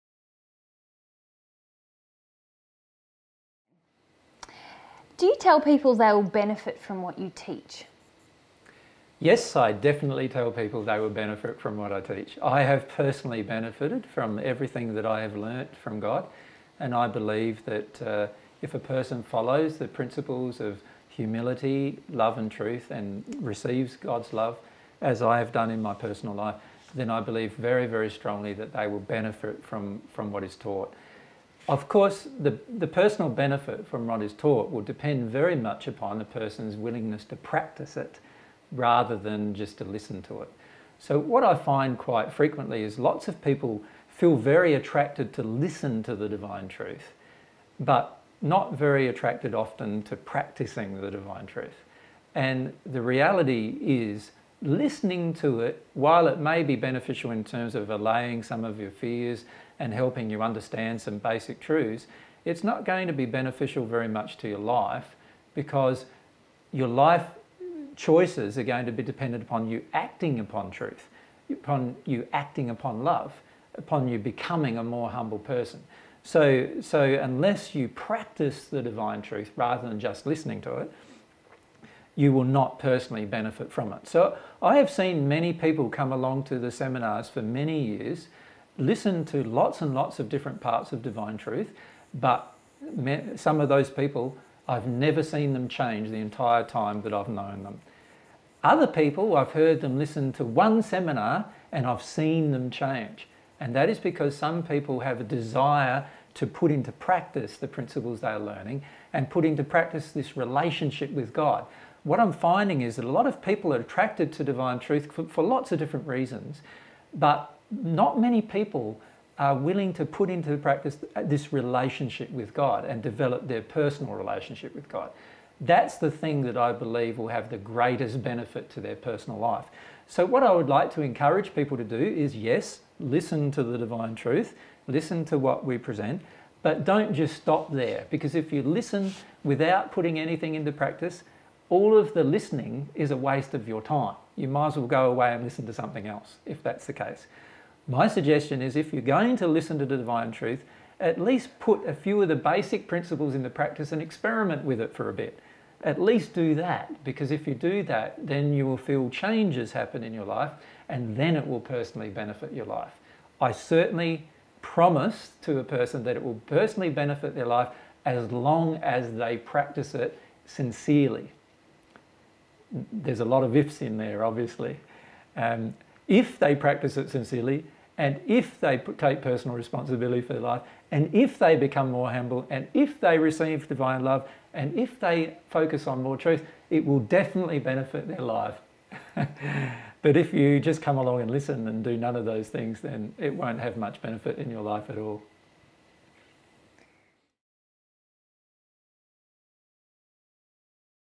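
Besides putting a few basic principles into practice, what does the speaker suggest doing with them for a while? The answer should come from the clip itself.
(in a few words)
experiment.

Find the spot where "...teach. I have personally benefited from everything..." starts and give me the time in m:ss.
0:12.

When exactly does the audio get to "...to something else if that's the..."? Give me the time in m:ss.
2:25.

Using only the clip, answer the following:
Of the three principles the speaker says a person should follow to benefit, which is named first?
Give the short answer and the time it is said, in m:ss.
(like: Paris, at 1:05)
humility, at 0:21.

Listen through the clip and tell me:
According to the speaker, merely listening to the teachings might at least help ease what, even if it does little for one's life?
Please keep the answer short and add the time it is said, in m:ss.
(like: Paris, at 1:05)
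fears, at 0:58.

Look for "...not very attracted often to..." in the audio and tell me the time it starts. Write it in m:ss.
0:48.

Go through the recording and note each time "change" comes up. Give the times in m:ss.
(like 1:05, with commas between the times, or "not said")
1:35, 1:42, 2:39.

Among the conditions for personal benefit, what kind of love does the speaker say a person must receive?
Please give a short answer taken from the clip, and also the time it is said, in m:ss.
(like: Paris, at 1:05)
divine love, at 3:03.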